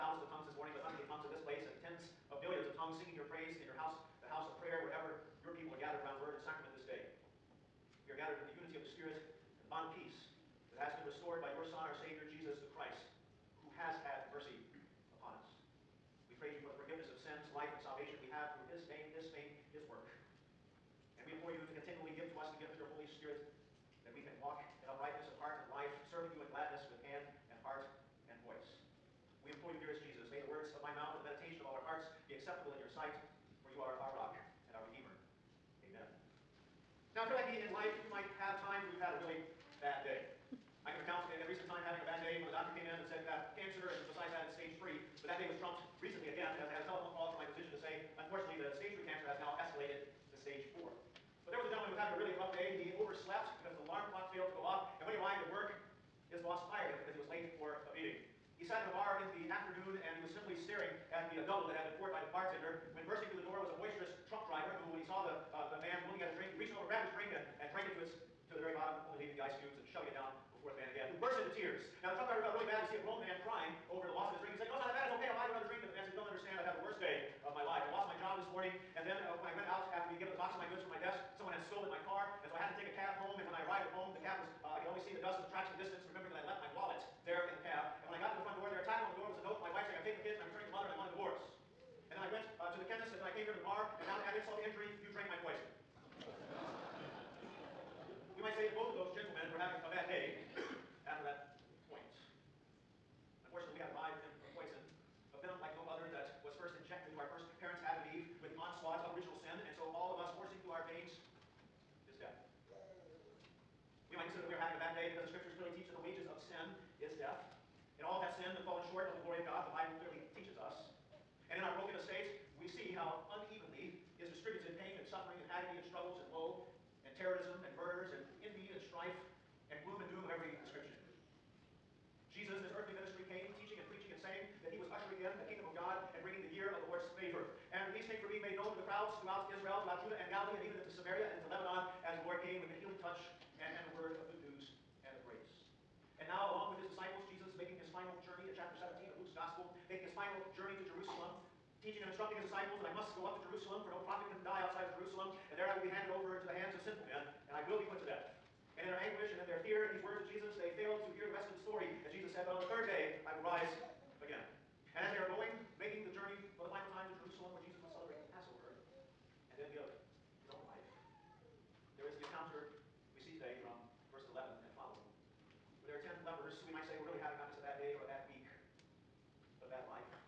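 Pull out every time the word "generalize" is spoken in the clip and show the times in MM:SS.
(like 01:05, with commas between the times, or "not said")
not said.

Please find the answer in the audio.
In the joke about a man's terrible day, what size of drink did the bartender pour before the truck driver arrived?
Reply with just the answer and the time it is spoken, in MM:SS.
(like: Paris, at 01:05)
double, at 01:01.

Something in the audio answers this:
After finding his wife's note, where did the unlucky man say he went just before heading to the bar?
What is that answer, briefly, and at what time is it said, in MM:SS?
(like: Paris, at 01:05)
the chemist, at 01:32.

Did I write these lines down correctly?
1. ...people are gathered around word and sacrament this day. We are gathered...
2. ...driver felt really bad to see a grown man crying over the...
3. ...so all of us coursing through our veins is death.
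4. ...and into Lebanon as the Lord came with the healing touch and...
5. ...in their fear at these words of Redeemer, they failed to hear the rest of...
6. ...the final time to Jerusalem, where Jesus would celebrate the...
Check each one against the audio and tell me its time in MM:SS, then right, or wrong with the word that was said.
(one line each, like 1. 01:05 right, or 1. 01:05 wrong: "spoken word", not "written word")
1. 00:05 right
2. 01:12 right
3. 01:49 right
4. 02:21 right
5. 02:39 wrong: "Jesus", not "Redeemer"
6. 02:46 right.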